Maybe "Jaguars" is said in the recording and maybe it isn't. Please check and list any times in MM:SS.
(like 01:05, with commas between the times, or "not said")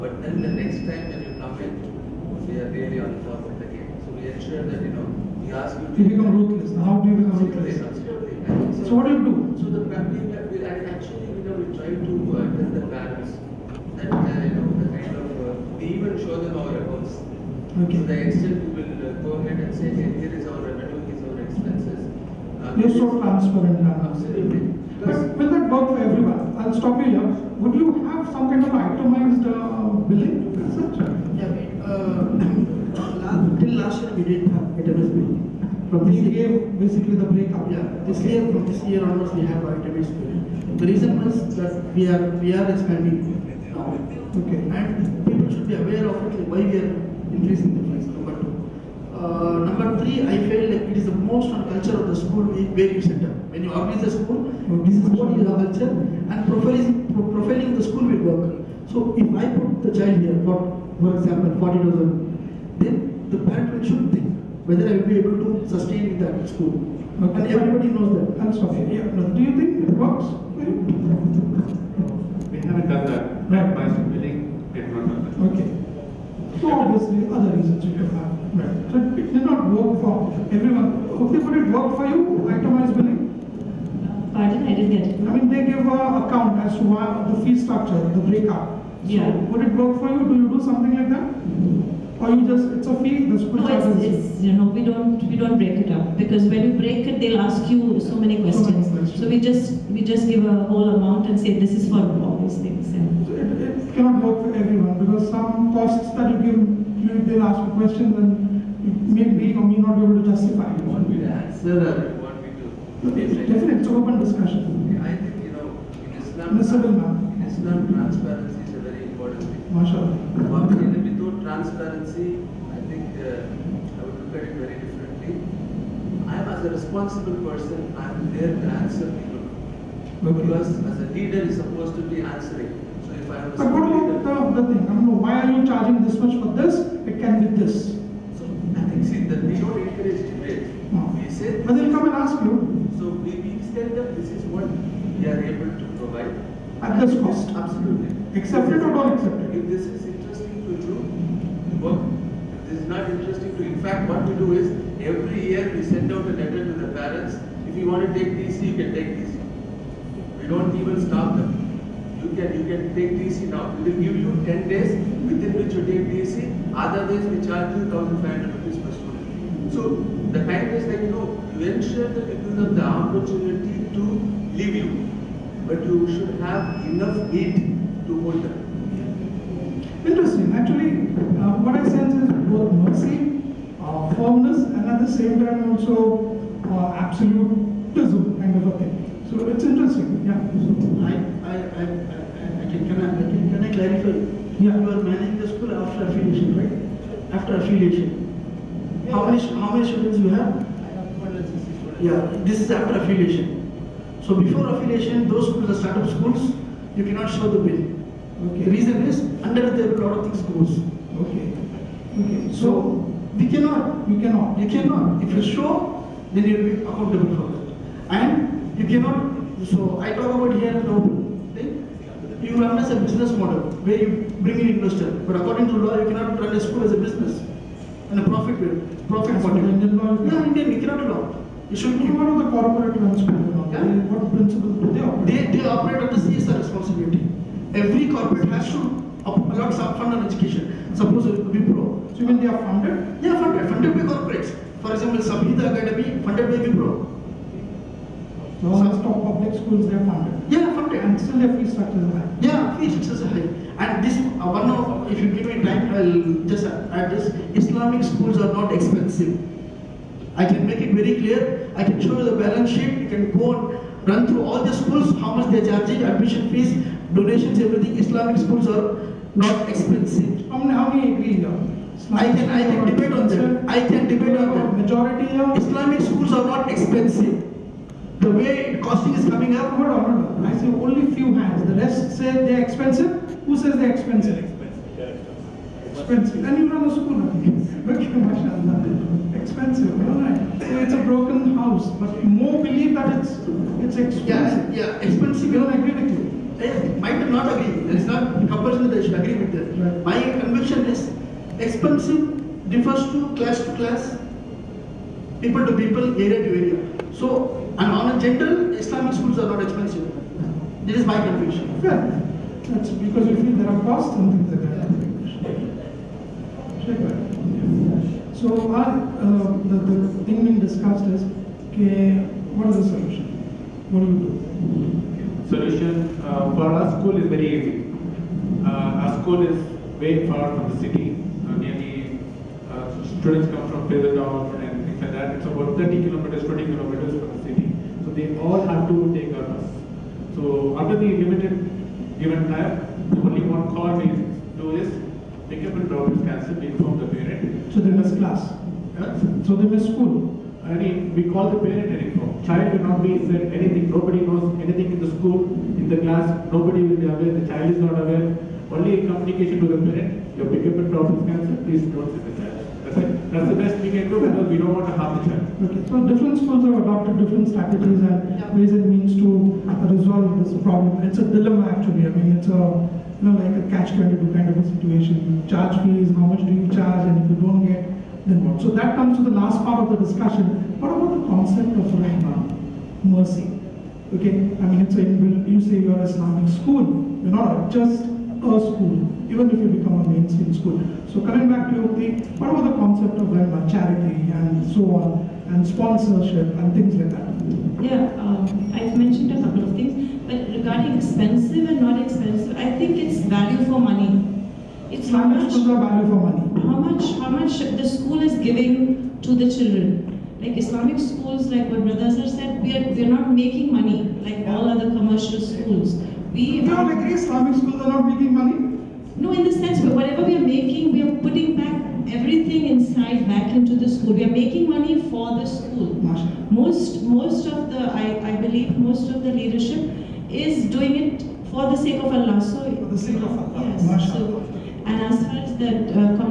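not said.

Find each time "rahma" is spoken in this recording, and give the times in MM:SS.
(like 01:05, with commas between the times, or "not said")
06:21, 06:33.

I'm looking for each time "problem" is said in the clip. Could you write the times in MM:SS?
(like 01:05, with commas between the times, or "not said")
06:00, 06:10.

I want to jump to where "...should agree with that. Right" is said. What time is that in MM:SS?
04:59.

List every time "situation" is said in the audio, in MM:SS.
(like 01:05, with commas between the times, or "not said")
06:14.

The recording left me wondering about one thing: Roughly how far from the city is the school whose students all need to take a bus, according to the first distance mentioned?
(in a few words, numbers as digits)
30 kilometers.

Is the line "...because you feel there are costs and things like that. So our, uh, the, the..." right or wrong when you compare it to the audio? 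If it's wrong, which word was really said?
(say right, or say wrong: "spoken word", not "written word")
right.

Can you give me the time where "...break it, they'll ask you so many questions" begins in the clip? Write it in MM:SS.
01:36.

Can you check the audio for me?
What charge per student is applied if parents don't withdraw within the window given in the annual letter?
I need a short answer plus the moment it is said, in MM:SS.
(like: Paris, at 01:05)
1,500 rupees, at 02:47.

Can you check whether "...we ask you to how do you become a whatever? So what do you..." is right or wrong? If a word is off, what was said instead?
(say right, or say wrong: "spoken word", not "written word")
wrong: "trader", not "whatever".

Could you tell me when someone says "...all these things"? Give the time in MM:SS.
01:41.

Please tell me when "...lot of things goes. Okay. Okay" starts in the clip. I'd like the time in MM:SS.
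03:30.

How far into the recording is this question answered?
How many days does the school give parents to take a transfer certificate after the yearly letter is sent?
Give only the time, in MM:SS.
02:44.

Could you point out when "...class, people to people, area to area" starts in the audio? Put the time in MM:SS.
05:03.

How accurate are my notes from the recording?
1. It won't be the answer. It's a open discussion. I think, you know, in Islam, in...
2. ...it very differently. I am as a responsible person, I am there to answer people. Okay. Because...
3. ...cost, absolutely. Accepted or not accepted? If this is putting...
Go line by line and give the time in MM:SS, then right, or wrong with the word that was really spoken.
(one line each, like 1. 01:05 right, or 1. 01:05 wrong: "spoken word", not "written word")
1. 01:50 right
2. 02:04 right
3. 02:27 wrong: "interesting", not "putting".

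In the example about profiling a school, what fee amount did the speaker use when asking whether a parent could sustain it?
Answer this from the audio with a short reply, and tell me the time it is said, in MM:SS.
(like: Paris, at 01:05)
40,000, at 01:01.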